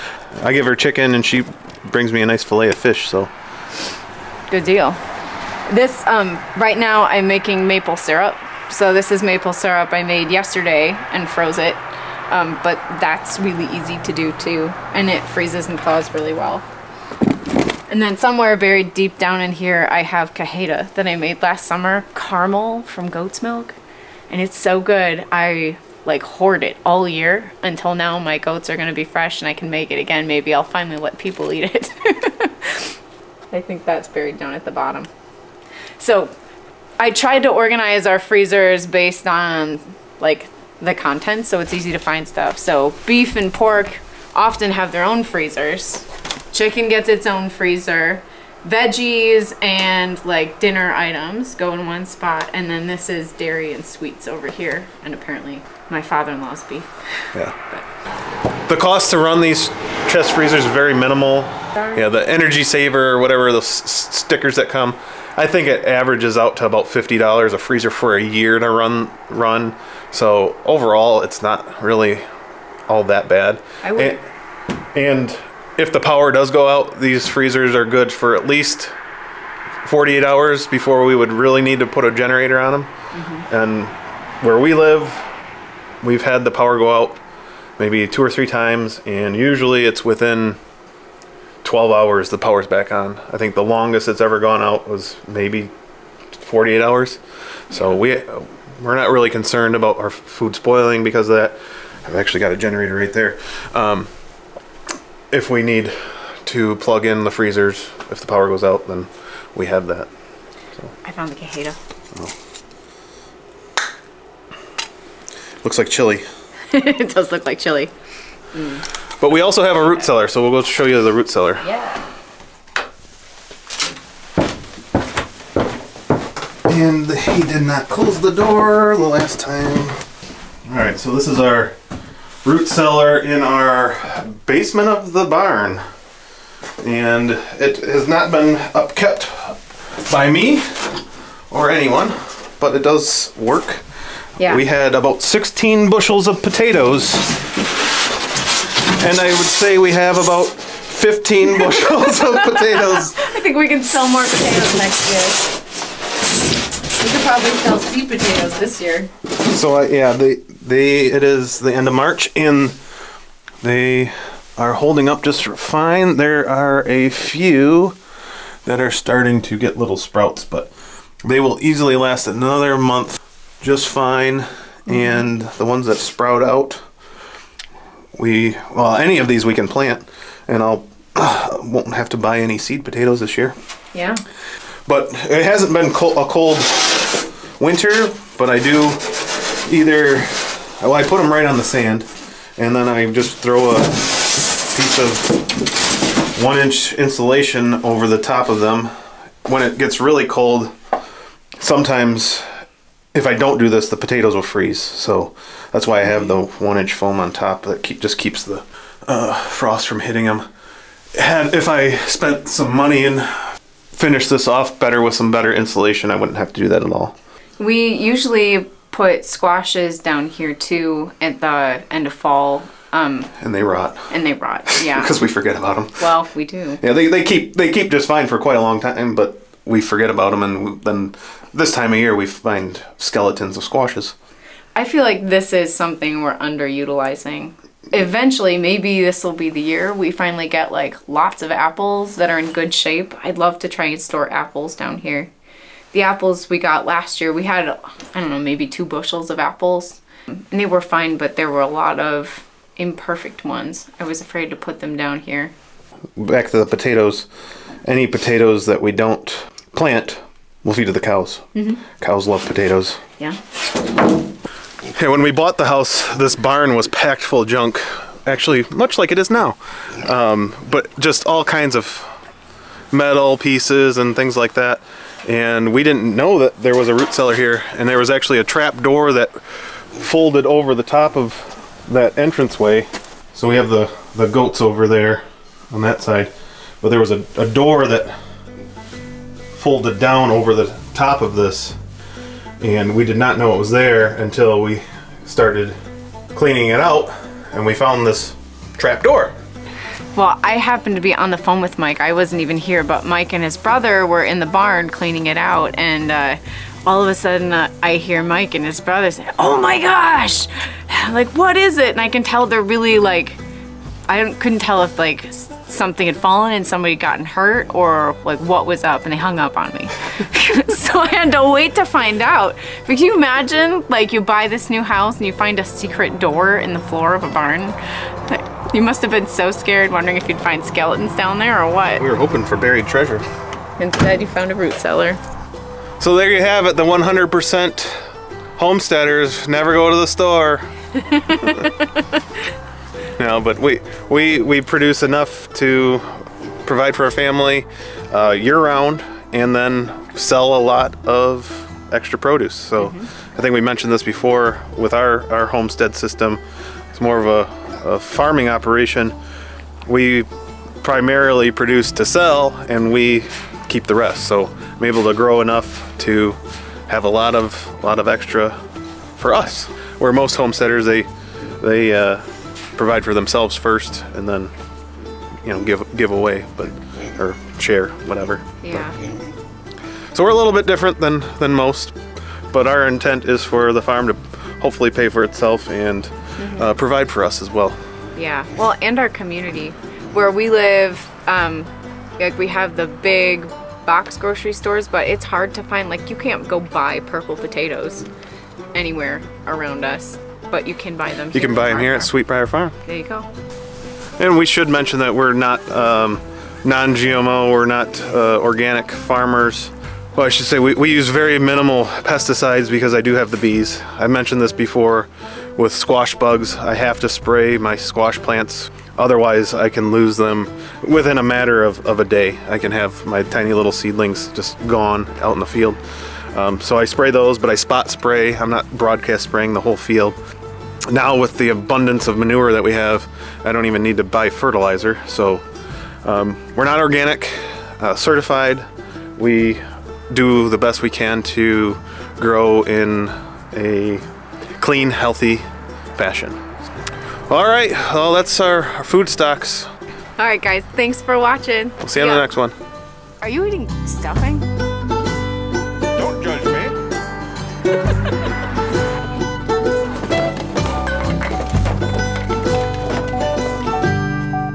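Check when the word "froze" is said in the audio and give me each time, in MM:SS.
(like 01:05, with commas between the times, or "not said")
00:11.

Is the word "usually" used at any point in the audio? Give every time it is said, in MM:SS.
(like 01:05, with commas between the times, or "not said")
01:29, 03:37.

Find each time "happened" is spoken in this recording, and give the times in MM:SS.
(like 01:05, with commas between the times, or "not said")
05:00.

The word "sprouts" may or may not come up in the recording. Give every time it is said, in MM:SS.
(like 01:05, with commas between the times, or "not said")
02:49, 02:55.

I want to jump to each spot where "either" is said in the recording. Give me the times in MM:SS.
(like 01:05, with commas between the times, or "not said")
03:09.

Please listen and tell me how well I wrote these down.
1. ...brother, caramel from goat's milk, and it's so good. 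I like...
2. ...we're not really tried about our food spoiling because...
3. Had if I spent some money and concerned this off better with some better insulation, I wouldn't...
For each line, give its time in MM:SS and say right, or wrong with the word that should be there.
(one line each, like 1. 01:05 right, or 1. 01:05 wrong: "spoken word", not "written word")
1. 00:21 wrong: "summer", not "brother"
2. 01:38 wrong: "concerned", not "tried"
3. 03:31 wrong: "finished", not "concerned".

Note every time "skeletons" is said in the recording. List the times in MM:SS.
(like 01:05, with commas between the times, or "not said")
03:52, 05:30.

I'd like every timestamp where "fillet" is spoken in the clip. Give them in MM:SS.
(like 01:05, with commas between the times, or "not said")
00:02.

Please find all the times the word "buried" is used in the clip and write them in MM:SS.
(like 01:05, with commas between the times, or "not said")
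00:18, 00:34, 05:32.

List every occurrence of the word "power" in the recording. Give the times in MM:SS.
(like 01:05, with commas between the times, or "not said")
01:15, 01:26, 01:32, 01:48.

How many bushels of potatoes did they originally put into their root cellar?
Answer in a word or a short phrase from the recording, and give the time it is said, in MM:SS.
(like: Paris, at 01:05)
16, at 02:24.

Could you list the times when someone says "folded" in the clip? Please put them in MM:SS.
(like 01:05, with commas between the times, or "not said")
04:39, 04:49.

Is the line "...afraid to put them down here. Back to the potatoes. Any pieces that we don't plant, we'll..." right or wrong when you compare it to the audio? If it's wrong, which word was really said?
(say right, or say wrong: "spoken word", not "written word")
wrong: "potatoes", not "pieces".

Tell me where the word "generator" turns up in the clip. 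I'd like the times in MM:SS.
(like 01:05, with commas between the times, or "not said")
01:22, 01:42.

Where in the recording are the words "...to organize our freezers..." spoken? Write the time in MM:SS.
00:37.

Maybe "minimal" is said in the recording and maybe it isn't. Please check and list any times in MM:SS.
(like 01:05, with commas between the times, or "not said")
01:00, 06:51.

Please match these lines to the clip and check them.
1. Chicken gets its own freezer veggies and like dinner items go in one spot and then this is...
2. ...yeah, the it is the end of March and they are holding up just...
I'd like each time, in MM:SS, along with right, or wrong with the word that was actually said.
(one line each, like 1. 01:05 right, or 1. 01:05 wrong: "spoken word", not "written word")
1. 00:46 right
2. 02:39 right.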